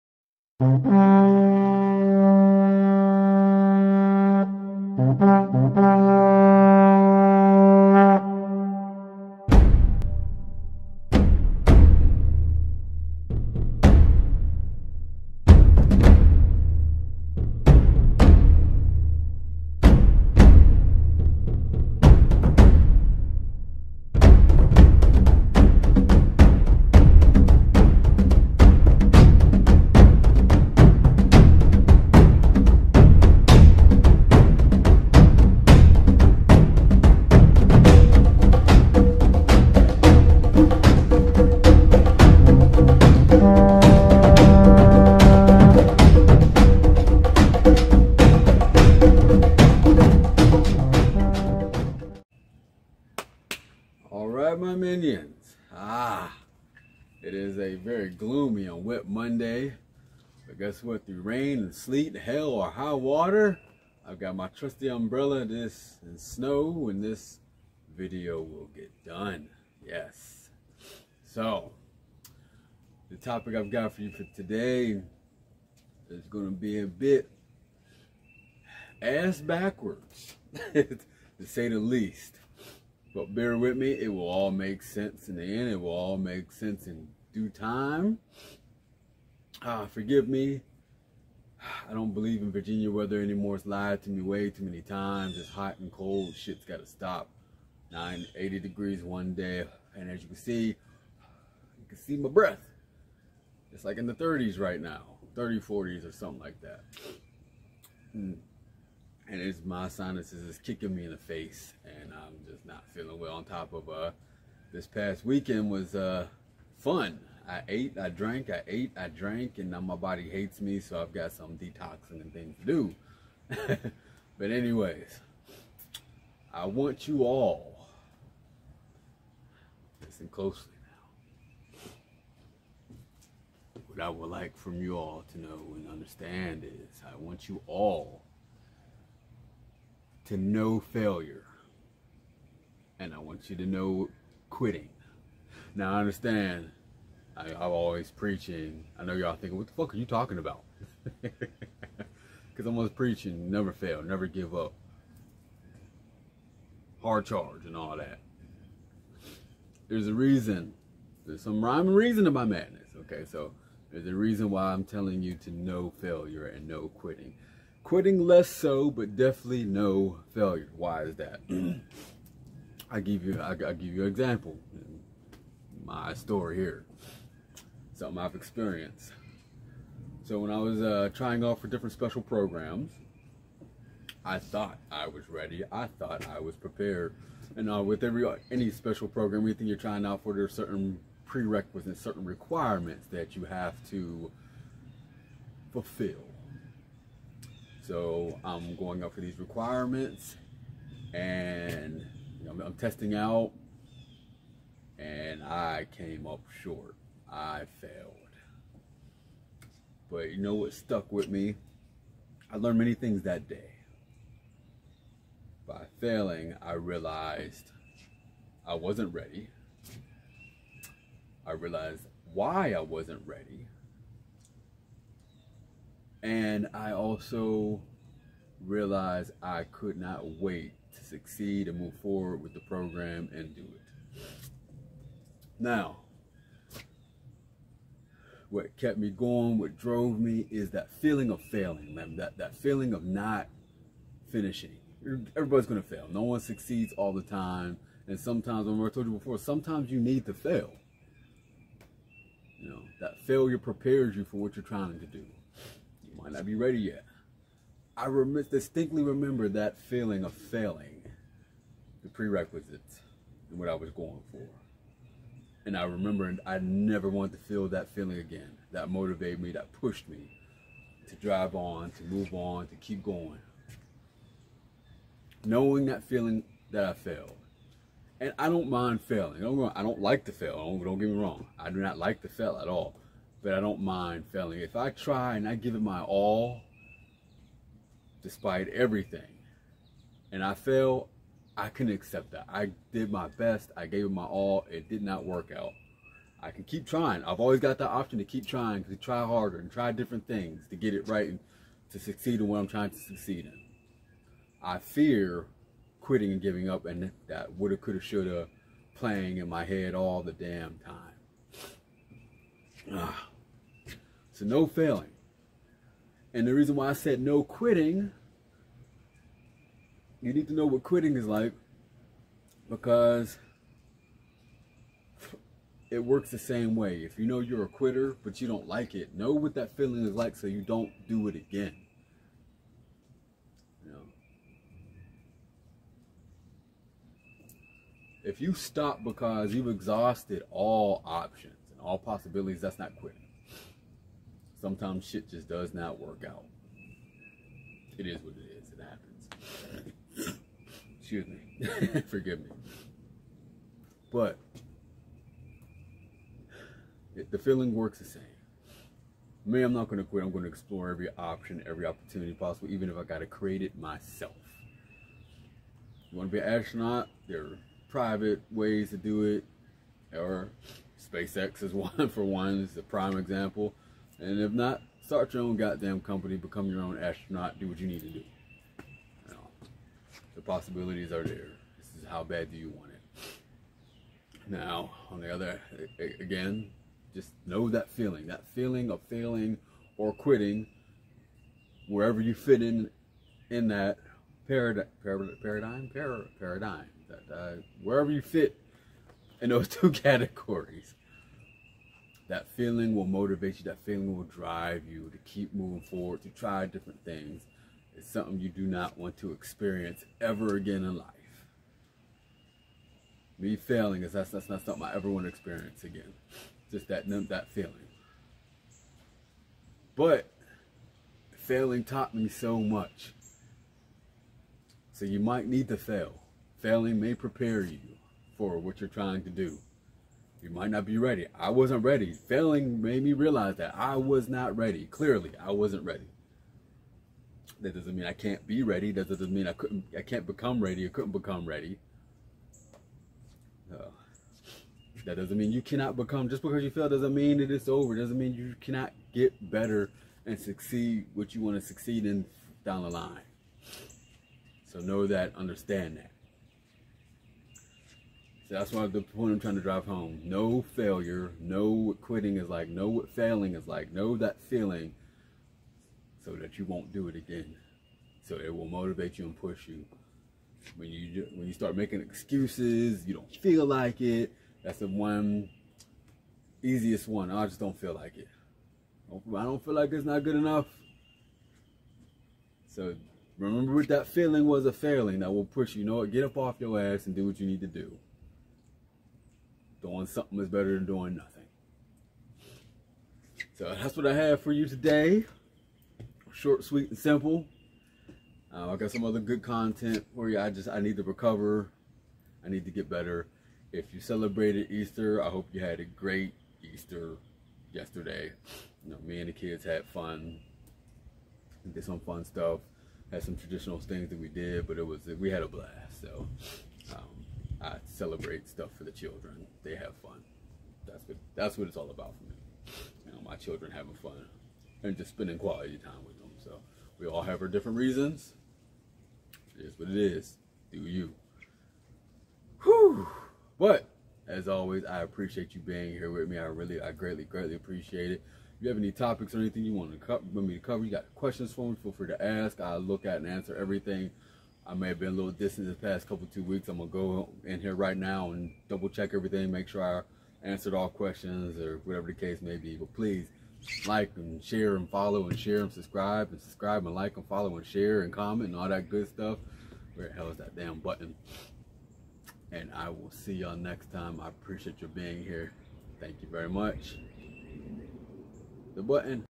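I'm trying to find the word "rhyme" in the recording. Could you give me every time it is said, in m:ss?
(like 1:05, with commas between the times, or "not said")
2:41.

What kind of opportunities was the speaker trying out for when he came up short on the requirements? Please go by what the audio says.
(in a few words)
special programs.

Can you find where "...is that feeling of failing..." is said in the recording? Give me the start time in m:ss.
4:00.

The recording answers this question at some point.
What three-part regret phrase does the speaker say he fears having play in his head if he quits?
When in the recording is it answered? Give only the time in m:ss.
5:07.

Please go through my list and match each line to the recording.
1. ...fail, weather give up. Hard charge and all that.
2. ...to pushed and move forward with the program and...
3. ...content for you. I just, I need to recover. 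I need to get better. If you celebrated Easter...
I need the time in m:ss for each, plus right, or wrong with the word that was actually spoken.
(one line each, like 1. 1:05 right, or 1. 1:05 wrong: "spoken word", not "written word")
1. 2:33 wrong: "never", not "weather"
2. 3:50 wrong: "succeed", not "pushed"
3. 8:19 right.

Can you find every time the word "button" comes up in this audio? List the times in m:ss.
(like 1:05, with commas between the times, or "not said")
9:20, 9:28.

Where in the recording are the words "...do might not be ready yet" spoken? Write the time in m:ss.
4:15.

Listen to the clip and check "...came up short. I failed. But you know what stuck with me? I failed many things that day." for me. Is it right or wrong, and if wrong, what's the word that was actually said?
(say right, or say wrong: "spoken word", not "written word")
wrong: "learned", not "failed".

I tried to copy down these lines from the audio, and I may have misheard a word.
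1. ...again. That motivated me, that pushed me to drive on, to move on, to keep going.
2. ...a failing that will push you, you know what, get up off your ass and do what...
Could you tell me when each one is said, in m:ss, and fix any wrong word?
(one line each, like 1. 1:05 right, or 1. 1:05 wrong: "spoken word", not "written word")
1. 4:28 right
2. 8:04 right.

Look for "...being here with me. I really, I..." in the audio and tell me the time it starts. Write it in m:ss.
8:55.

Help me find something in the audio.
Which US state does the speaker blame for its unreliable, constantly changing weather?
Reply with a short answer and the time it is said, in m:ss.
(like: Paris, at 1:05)
Virginia, at 1:32.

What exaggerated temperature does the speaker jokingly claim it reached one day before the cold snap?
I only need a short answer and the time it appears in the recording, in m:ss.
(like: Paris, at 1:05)
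980 degrees, at 1:37.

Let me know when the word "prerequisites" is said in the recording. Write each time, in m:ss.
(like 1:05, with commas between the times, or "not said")
3:11, 4:22.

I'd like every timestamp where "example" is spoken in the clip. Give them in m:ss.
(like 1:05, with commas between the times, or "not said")
2:54, 6:13.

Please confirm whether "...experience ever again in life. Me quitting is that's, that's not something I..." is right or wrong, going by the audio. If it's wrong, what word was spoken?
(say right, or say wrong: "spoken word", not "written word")
wrong: "failing", not "quitting".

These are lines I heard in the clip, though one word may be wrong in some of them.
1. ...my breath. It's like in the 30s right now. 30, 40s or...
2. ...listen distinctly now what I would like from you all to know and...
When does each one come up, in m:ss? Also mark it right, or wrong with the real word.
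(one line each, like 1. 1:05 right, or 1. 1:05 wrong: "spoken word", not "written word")
1. 1:42 right
2. 2:10 wrong: "closely", not "distinctly".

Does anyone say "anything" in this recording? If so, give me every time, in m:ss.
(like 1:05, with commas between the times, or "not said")
3:09, 8:59.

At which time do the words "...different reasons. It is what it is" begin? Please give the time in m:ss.
8:47.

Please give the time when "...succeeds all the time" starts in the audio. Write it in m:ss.
4:06.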